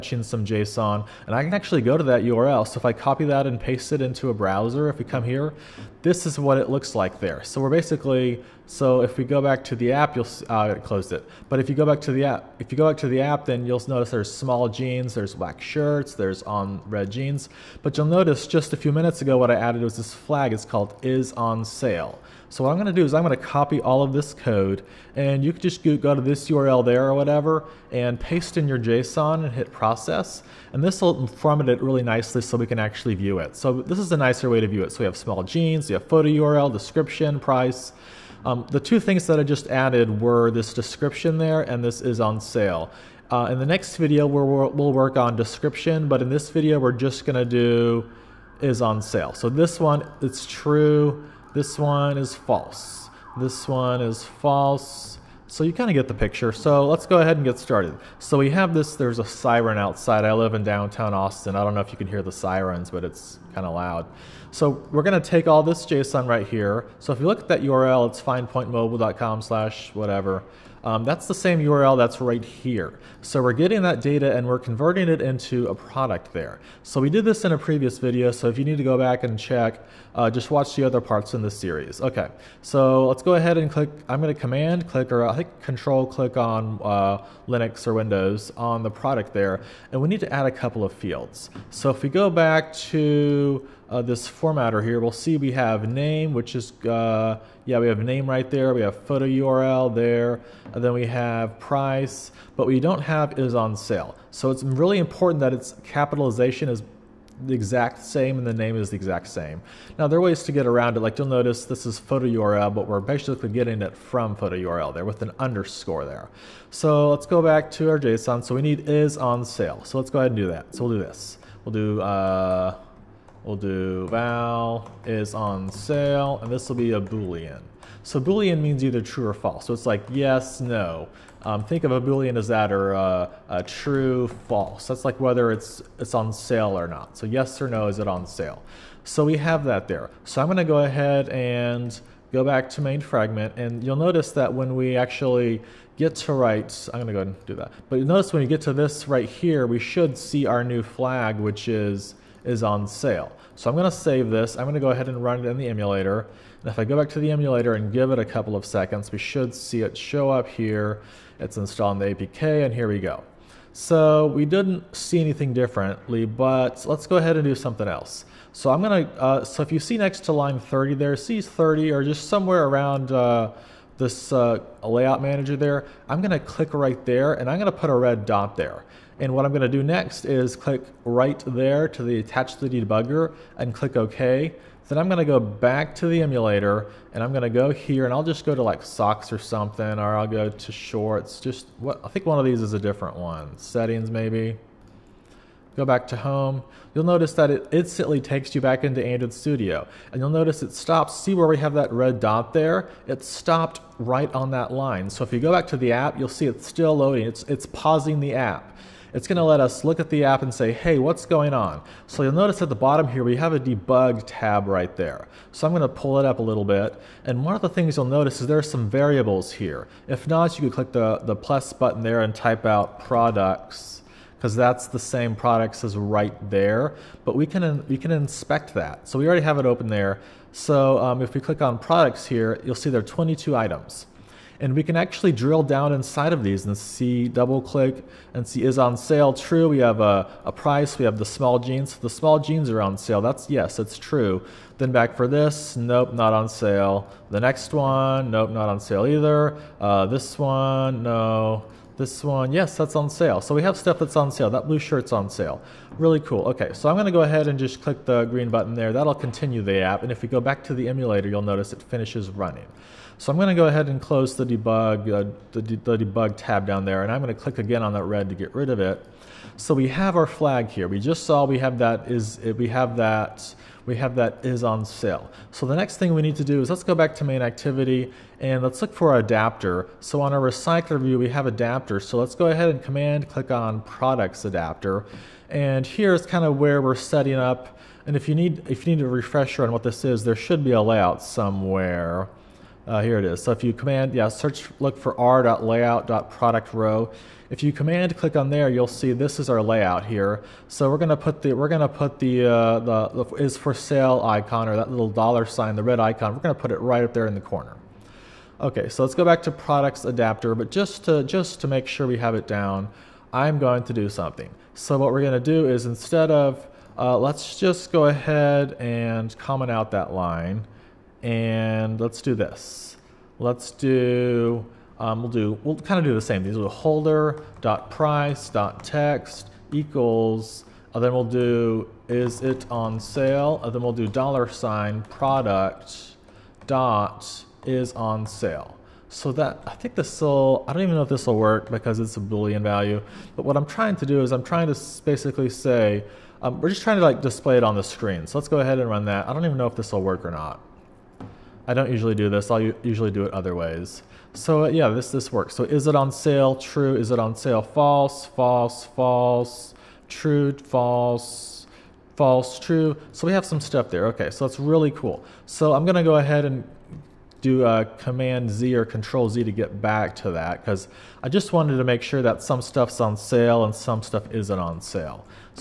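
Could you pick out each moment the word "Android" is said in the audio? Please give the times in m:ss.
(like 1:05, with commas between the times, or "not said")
3:19.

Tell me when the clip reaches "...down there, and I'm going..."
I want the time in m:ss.
4:26.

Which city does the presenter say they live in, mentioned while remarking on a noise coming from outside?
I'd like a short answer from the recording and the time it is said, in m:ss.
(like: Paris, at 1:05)
Austin, at 1:01.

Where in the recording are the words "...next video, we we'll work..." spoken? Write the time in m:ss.
0:43.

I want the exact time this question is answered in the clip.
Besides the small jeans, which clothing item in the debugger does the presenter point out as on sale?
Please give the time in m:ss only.
4:14.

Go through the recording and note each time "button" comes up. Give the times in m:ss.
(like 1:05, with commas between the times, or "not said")
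3:41, 4:18.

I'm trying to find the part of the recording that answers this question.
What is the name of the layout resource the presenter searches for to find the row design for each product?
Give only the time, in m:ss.
4:55.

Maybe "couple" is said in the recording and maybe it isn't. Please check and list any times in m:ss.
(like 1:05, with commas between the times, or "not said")
1:30, 2:38.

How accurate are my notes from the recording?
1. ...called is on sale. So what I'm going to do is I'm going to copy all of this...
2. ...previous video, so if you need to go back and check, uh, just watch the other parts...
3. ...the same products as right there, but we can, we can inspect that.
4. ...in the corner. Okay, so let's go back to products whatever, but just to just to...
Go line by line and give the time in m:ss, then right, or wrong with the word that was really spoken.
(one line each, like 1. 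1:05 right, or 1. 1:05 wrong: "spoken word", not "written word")
1. 0:20 right
2. 1:17 right
3. 3:44 right
4. 5:07 wrong: "adapter", not "whatever".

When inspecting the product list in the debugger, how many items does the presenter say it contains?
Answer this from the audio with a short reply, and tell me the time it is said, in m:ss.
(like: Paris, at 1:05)
22, at 3:53.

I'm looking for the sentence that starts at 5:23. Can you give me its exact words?
Let's do, um, we'll do, we'll kind of do the same.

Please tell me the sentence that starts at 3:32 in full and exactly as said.
So you'll notice at the bottom here, we have a debug tab right there.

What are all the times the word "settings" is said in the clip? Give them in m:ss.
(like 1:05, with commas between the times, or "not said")
3:13, 4:46.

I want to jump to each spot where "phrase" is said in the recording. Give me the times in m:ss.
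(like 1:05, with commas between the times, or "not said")
not said.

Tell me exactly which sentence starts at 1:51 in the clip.
Like you'll notice this is photo URL, but we're basically getting it from photo URL there with an underscore there.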